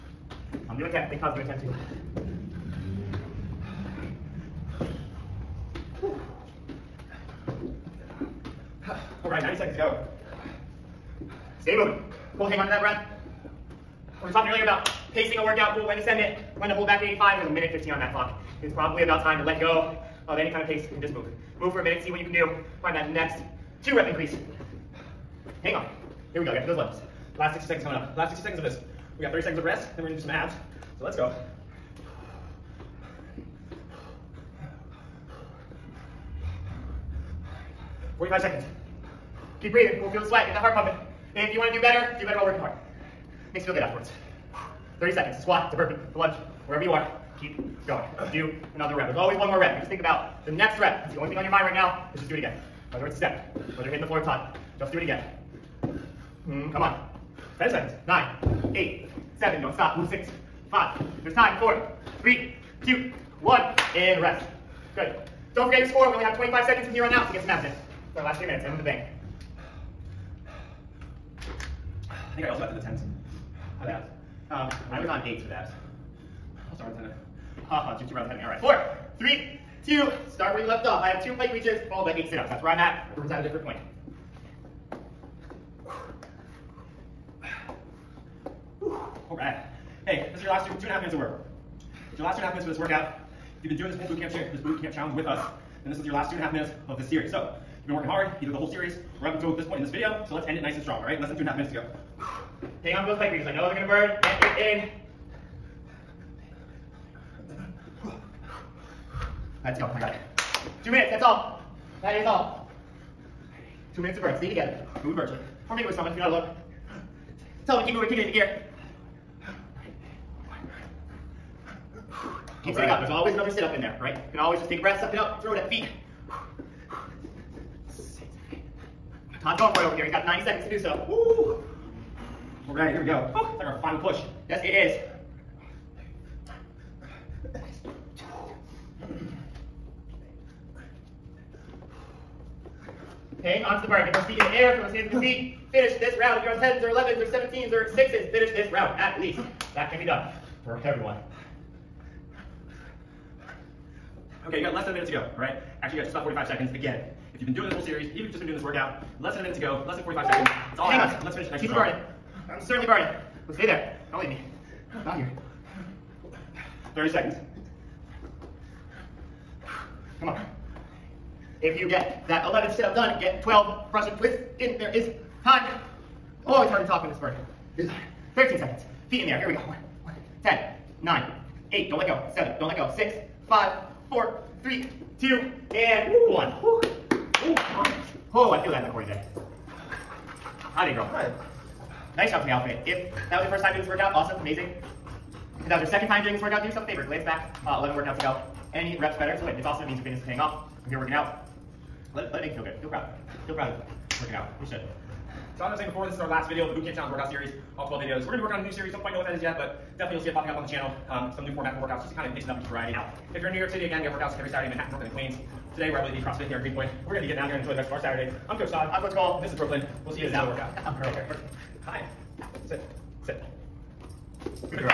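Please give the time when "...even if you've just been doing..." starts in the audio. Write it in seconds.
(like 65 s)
158 s.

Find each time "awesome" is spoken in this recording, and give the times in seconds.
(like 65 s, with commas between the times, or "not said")
194 s, 199 s.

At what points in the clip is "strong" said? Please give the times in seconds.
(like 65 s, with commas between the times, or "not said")
100 s, 161 s.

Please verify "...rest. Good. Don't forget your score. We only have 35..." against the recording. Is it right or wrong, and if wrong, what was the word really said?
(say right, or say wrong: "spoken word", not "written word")
wrong: "25", not "35".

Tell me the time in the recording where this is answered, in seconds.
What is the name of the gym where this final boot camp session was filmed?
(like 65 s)
216 s.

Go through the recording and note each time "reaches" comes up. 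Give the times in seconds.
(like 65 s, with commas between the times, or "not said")
81 s, 103 s.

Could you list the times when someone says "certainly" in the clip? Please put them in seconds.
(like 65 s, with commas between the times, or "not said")
162 s.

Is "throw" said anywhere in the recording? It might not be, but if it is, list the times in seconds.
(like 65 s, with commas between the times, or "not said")
125 s, 144 s.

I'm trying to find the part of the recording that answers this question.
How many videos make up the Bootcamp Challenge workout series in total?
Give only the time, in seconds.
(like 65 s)
207 s.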